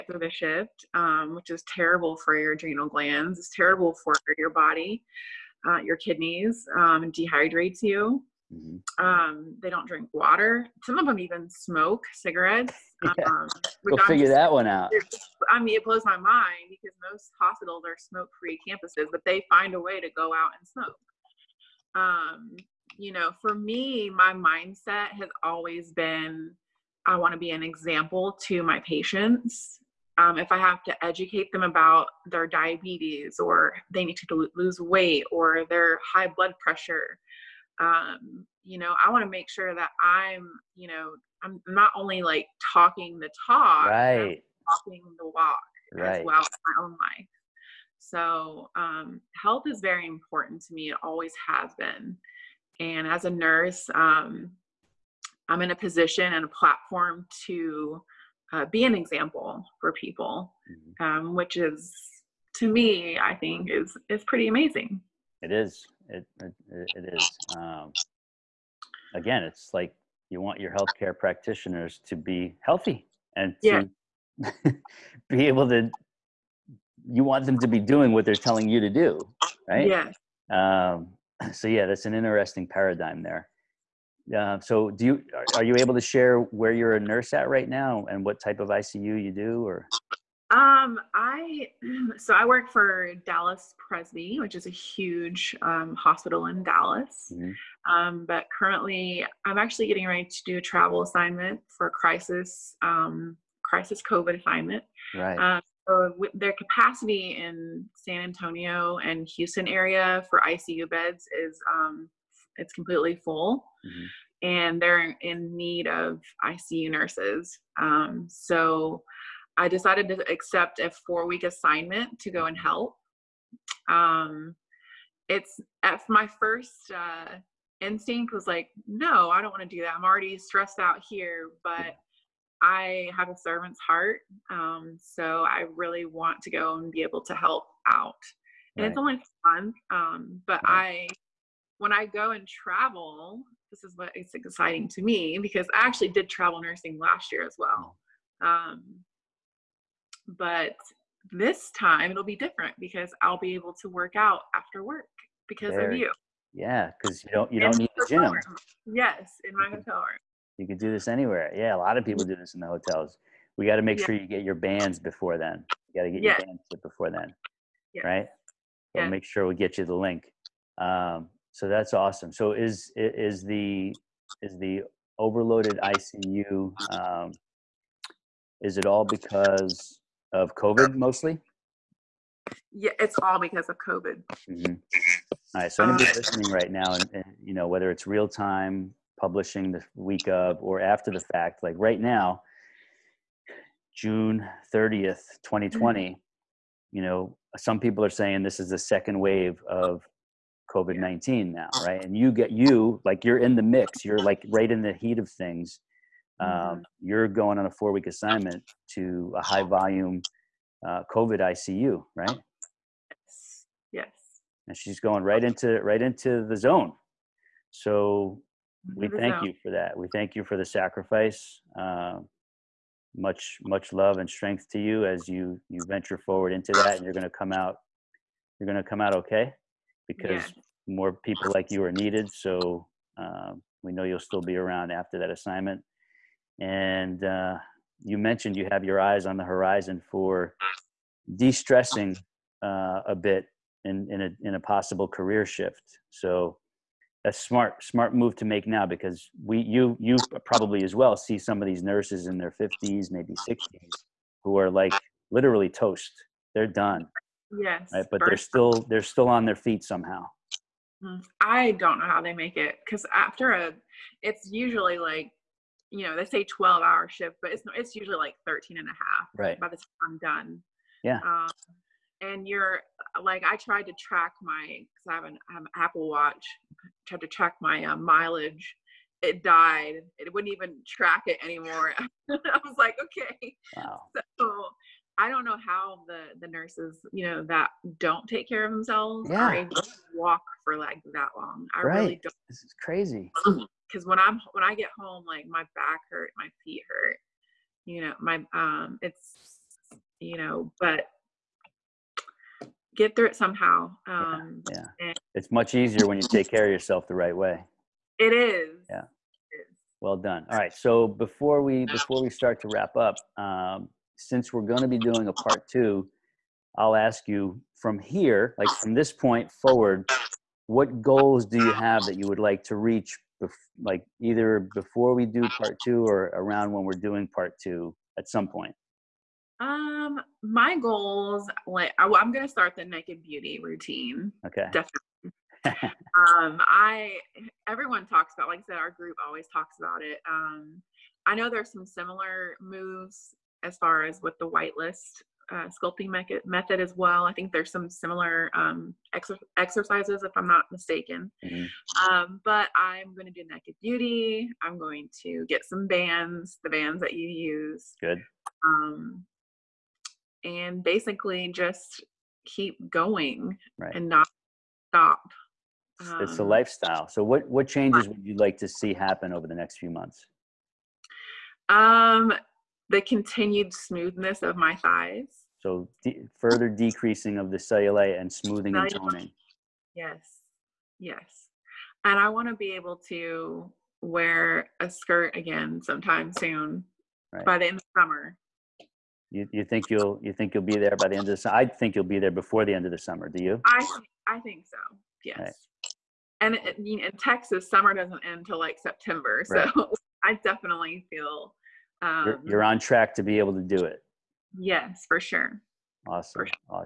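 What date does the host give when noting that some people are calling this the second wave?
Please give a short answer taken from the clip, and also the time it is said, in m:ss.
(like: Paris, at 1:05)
June 30, 2020, at 3:13.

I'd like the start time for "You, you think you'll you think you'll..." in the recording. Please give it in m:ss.
6:29.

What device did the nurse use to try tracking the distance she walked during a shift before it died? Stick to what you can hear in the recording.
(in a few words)
Apple Watch.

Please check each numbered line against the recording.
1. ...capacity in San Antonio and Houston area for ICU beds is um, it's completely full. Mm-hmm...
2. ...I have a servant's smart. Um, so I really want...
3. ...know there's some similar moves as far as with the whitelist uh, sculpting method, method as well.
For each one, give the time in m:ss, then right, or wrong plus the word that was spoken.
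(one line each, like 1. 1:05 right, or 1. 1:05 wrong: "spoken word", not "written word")
1. 1:46 right
2. 2:12 wrong: "heart", not "smart"
3. 5:41 right.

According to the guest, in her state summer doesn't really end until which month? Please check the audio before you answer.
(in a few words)
September.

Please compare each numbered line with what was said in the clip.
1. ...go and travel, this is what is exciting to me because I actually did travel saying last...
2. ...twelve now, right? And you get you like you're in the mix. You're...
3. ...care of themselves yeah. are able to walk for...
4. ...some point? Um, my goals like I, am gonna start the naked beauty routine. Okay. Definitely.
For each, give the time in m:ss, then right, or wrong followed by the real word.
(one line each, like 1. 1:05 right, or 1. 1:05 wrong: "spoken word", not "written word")
1. 2:22 wrong: "nursing", not "saying"
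2. 3:20 wrong: "nineteen", not "twelve"
3. 4:48 right
4. 5:28 right.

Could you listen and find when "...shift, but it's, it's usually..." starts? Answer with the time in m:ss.
4:27.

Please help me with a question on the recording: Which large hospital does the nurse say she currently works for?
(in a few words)
Dallas Presby.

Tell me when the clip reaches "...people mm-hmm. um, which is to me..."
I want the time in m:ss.
0:59.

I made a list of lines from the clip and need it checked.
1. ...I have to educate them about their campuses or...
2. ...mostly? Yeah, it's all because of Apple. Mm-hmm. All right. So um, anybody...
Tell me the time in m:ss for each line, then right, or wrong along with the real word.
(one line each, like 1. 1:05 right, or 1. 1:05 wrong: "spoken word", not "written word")
1. 0:30 wrong: "diabetes", not "campuses"
2. 3:00 wrong: "COVID", not "Apple".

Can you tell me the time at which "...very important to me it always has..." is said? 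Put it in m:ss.
0:49.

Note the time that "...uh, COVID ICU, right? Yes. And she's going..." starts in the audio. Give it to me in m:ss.
3:30.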